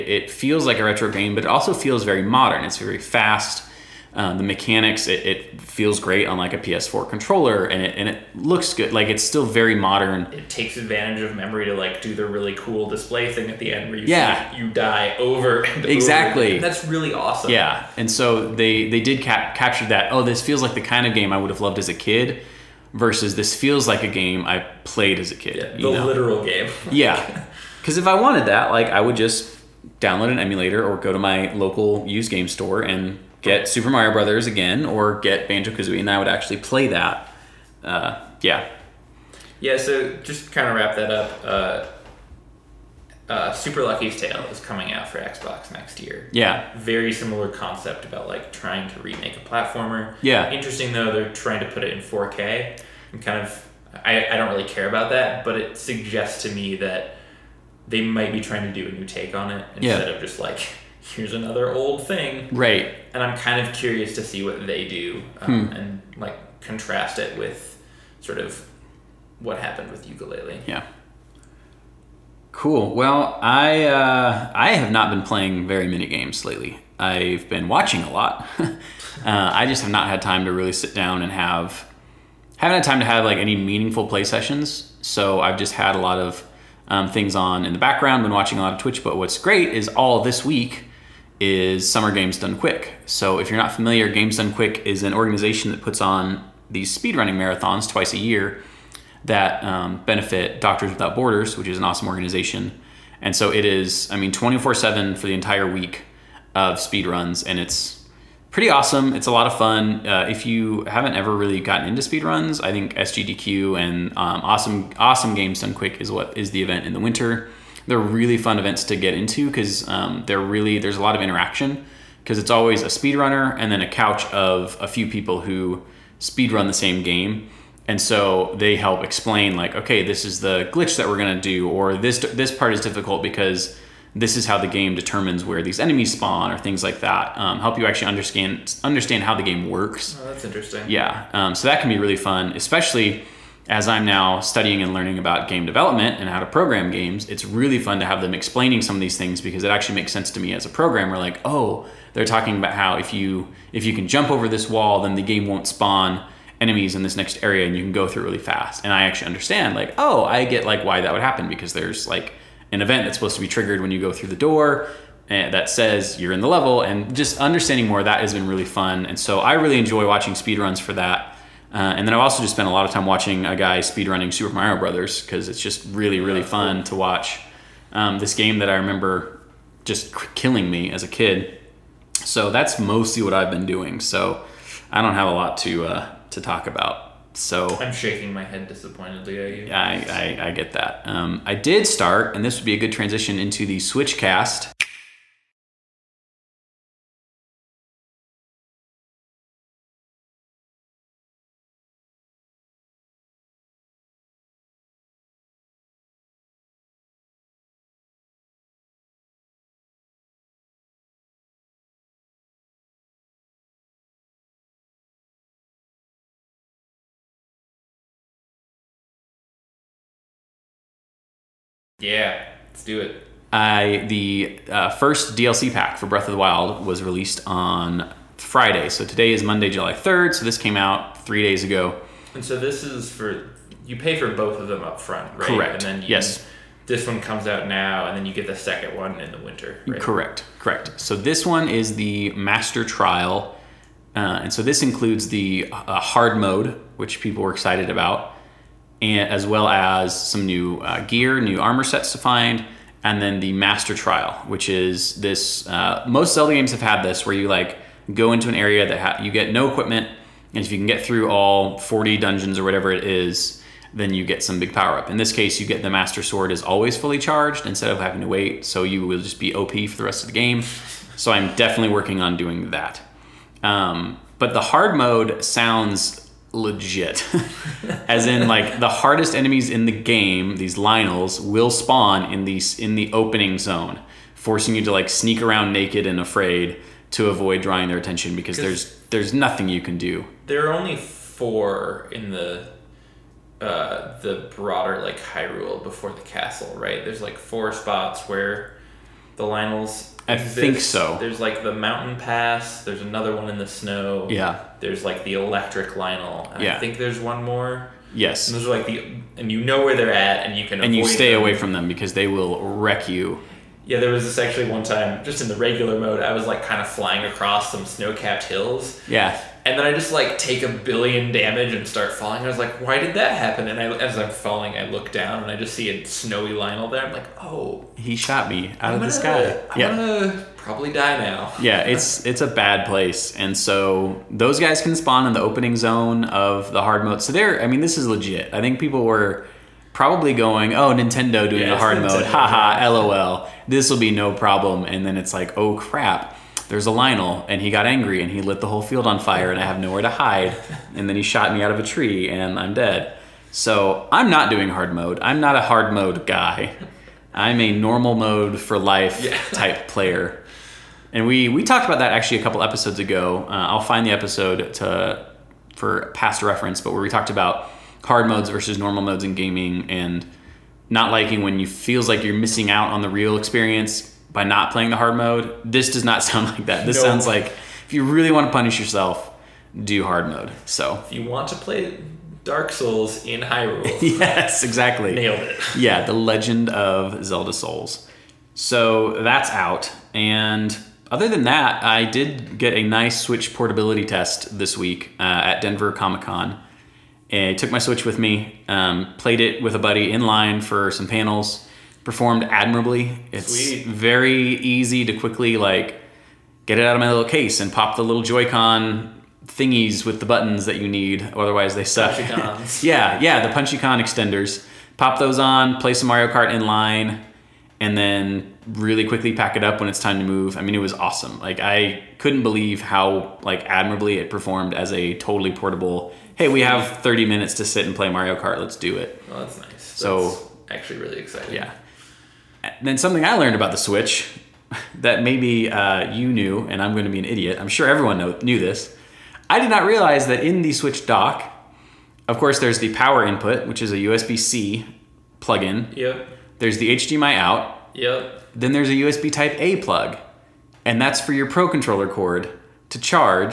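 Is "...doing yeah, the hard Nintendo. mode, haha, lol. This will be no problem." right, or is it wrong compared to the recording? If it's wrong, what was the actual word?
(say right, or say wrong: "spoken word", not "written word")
right.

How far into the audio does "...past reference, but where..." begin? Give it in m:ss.
6:06.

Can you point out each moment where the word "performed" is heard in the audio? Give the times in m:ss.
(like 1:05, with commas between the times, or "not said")
6:42, 7:04.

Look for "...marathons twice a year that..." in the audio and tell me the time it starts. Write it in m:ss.
1:37.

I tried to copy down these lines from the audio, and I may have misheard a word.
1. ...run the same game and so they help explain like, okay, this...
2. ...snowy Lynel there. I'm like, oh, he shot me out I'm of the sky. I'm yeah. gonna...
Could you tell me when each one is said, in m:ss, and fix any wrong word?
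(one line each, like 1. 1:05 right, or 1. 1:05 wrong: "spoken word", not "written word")
1. 2:06 right
2. 5:26 right.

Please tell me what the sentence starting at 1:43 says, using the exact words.
And so it is, I mean, 24 7 for the entire week of speed runs, and it's pretty awesome.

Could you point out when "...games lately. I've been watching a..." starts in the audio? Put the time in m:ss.
1:16.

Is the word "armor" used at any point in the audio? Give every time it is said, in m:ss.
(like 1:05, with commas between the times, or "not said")
4:11.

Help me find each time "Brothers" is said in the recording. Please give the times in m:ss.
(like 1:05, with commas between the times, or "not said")
0:34, 2:54.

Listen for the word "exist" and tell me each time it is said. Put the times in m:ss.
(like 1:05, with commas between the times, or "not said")
5:00.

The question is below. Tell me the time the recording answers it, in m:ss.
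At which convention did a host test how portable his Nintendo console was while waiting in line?
6:35.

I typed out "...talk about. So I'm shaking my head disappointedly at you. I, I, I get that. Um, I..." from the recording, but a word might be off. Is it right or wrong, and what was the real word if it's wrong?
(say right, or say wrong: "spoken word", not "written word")
right.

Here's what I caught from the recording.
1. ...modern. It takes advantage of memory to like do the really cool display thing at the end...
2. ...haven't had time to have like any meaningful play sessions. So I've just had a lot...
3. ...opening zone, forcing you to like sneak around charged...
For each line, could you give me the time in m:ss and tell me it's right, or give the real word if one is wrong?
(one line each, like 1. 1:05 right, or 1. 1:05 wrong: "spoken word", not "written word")
1. 0:09 right
2. 1:22 right
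3. 4:43 wrong: "naked", not "charged".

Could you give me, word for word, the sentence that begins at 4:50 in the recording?
There are only four in the uh, the broader like Hyrule before the castle, right?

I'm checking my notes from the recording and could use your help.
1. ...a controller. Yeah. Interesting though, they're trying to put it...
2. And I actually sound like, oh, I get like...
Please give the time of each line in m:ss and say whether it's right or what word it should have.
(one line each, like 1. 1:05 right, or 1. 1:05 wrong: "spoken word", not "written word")
1. 0:49 wrong: "platformer", not "controller"
2. 2:38 wrong: "understand", not "sound".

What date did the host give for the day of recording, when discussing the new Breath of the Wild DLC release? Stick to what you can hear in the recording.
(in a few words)
July 3.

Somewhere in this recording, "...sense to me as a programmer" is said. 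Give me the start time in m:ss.
2:30.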